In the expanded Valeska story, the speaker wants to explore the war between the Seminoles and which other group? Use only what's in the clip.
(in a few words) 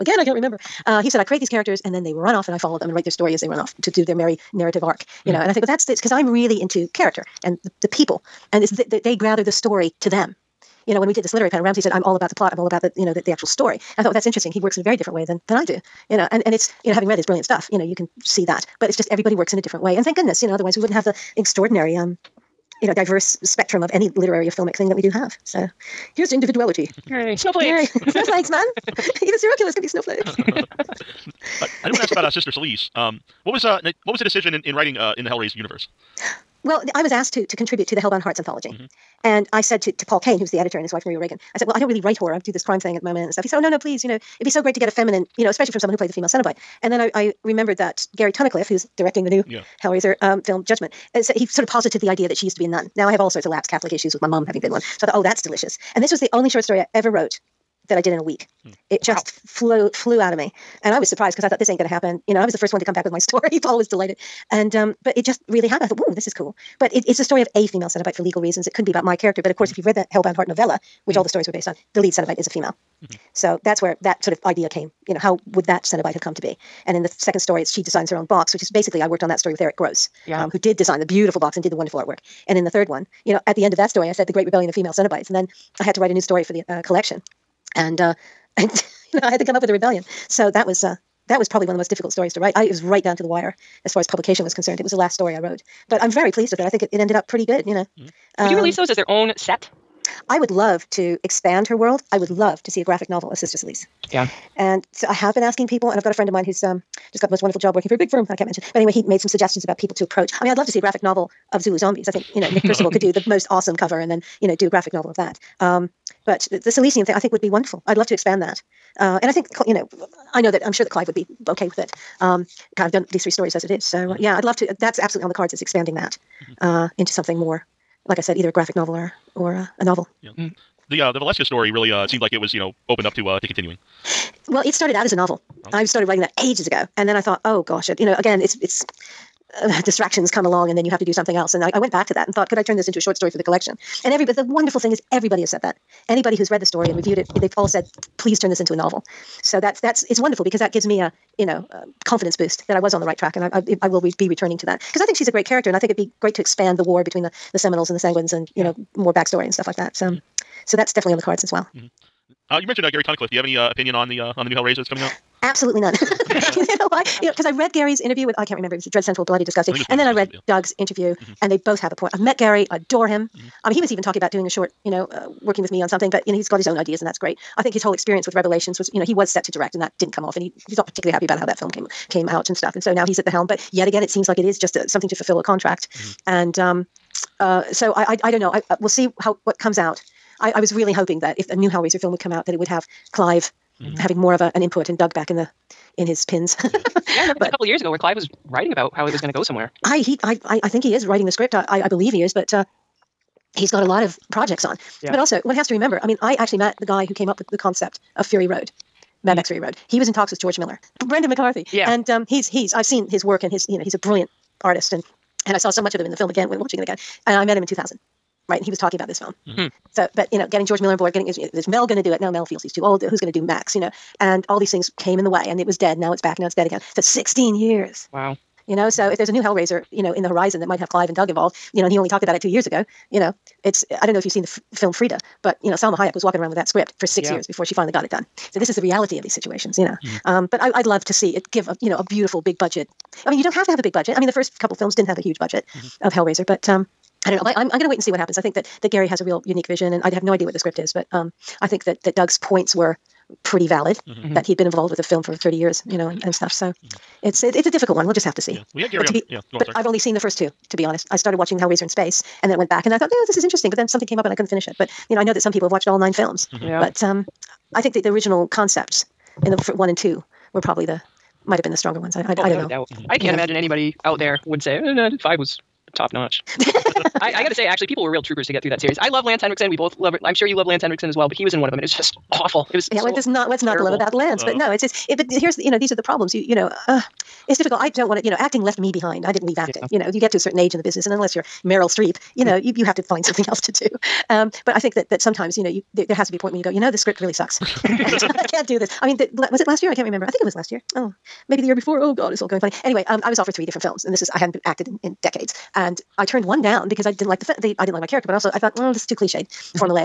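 the Sanguines.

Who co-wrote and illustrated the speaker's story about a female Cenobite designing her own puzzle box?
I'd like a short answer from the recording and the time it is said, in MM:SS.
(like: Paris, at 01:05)
Eric Gross, at 01:19.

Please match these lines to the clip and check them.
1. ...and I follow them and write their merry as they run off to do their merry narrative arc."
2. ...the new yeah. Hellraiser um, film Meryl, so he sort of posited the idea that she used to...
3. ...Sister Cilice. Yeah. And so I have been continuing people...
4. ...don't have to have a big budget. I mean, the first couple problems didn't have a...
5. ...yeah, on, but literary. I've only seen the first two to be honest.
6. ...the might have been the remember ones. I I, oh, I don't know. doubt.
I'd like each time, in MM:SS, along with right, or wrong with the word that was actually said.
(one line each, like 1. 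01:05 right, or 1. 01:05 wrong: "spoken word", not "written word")
1. 00:02 wrong: "story", not "merry"
2. 00:49 wrong: "Judgment", not "Meryl"
3. 01:43 wrong: "asking", not "continuing"
4. 04:03 wrong: "films", not "problems"
5. 04:19 wrong: "sorry", not "literary"
6. 04:30 wrong: "stronger", not "remember".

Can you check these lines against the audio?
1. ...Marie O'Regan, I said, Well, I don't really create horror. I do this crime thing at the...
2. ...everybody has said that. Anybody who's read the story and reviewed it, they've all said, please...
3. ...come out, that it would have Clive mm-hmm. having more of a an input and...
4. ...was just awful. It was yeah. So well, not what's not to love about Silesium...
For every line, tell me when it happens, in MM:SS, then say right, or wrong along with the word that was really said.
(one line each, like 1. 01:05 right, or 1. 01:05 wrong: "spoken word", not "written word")
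1. 00:41 wrong: "write", not "create"
2. 02:25 right
3. 03:12 right
4. 04:41 wrong: "Lance", not "Silesium".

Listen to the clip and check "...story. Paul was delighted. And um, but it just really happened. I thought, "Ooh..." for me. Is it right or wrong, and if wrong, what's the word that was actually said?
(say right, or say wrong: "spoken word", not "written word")
right.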